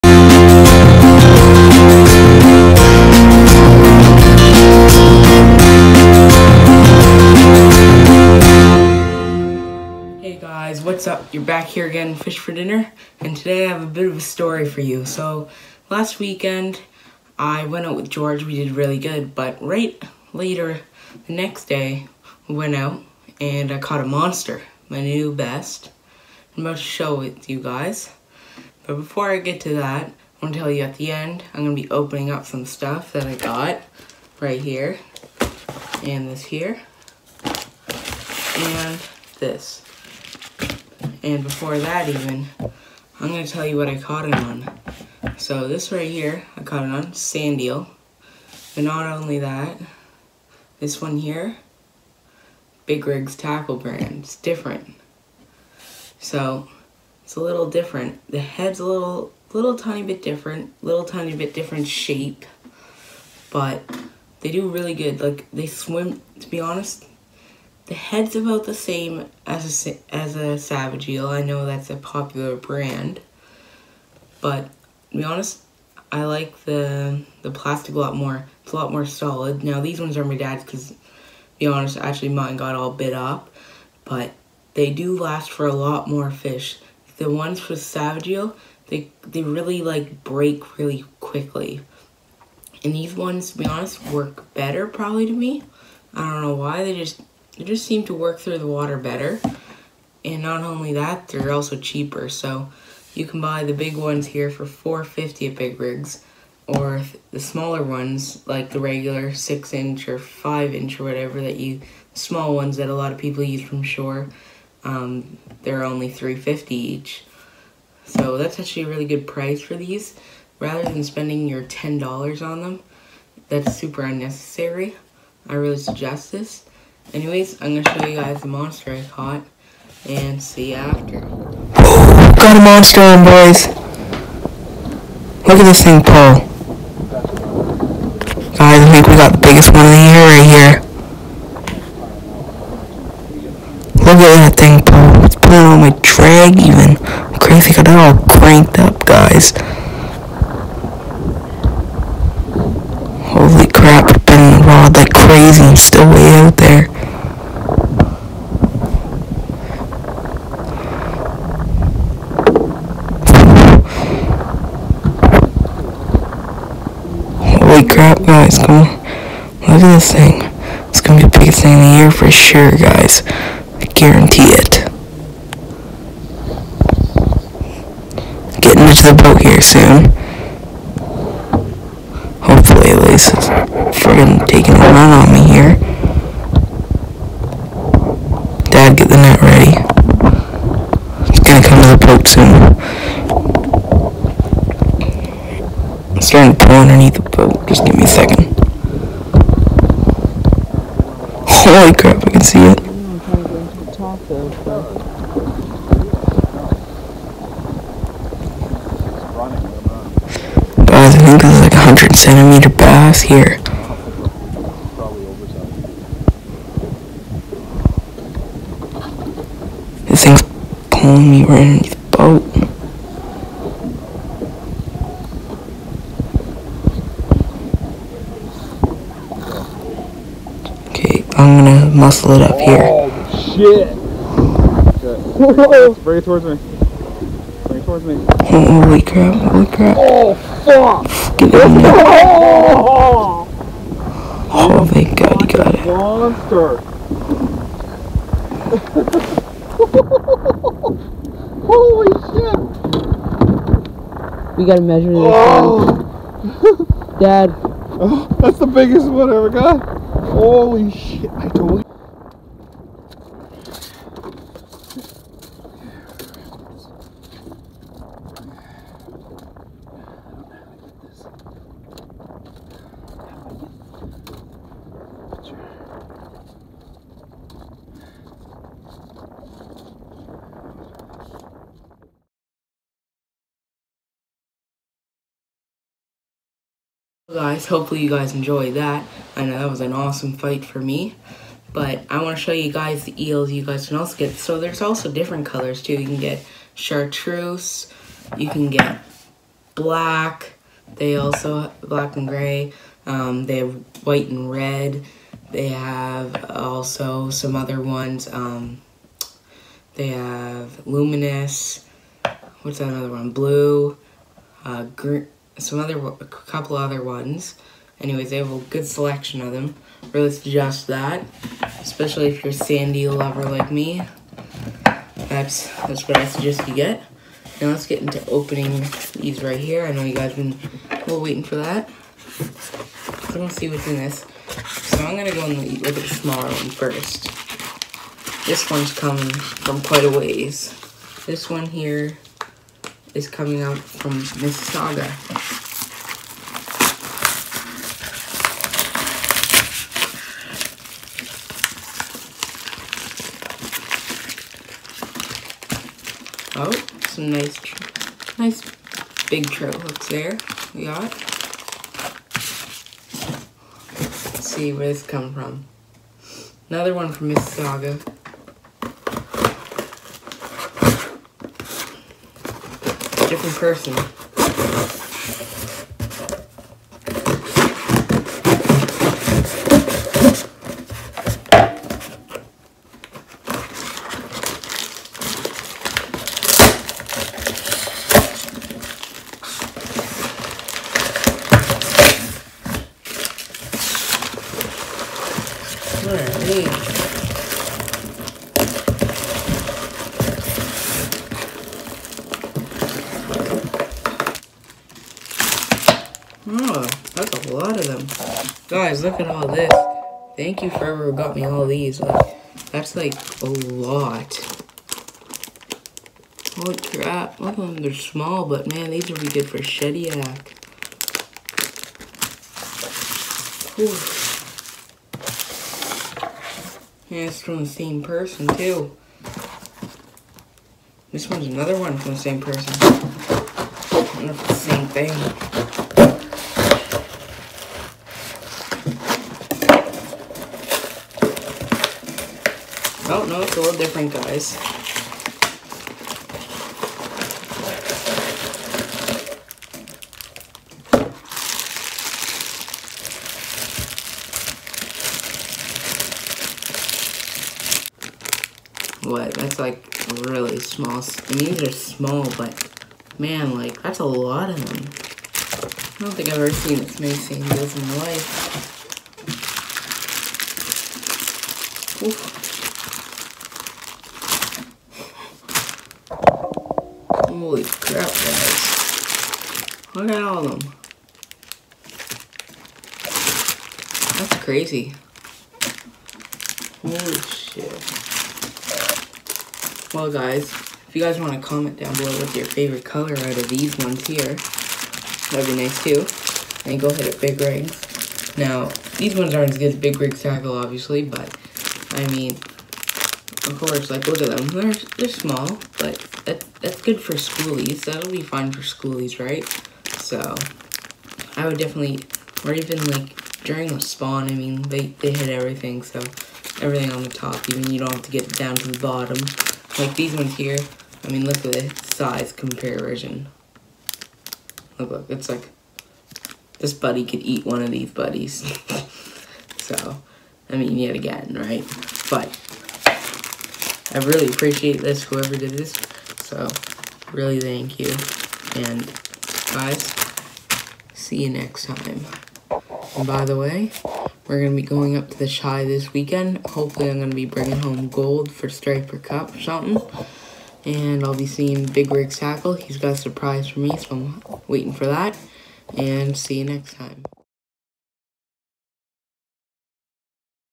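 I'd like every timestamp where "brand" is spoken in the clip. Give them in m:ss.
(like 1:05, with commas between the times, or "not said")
0:53, 1:12.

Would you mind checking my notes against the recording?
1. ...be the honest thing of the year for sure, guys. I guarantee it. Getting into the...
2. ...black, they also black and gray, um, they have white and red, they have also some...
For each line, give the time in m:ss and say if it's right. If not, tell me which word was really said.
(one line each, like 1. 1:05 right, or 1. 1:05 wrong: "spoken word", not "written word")
1. 2:51 wrong: "biggest", not "honest"
2. 4:59 right.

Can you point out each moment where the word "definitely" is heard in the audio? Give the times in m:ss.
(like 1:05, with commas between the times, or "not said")
8:31.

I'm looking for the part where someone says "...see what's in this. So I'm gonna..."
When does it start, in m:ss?
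5:33.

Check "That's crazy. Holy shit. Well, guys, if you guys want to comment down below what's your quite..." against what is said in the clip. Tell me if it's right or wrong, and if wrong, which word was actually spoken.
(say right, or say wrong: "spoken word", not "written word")
wrong: "favorite", not "quite".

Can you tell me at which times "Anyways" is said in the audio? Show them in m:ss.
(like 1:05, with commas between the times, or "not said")
2:07, 5:18.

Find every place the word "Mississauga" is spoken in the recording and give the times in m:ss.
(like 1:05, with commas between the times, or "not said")
5:44, 6:07.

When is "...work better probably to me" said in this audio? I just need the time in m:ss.
1:34.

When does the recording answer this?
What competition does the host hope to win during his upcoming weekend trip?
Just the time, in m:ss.
9:08.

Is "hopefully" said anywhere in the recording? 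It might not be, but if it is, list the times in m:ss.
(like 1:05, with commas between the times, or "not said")
3:02, 4:47, 9:06.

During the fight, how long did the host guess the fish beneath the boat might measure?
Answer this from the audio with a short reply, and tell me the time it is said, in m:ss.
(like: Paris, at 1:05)
100 centimeters, at 3:31.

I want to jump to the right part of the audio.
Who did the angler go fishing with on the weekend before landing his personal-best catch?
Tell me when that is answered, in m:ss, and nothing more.
0:18.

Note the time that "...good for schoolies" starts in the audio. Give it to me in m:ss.
8:26.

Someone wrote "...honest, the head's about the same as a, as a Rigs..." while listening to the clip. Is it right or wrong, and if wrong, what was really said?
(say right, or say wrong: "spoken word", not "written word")
wrong: "Savage", not "Rigs".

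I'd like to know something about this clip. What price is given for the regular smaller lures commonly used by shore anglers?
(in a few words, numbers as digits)
$3.50.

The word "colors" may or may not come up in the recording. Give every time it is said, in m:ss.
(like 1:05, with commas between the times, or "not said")
4:55, 8:12.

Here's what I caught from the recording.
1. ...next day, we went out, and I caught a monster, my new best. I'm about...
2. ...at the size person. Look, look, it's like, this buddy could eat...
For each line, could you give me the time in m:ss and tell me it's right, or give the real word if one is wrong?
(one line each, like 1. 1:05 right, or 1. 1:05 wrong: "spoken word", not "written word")
1. 0:21 right
2. 8:41 wrong: "comparison", not "person".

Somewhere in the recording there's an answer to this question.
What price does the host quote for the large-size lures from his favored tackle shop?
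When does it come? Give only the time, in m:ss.
1:44.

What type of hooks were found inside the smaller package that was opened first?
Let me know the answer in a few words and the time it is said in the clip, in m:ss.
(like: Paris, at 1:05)
Trout hooks, at 5:59.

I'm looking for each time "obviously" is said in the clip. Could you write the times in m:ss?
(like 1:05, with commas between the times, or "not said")
8:20.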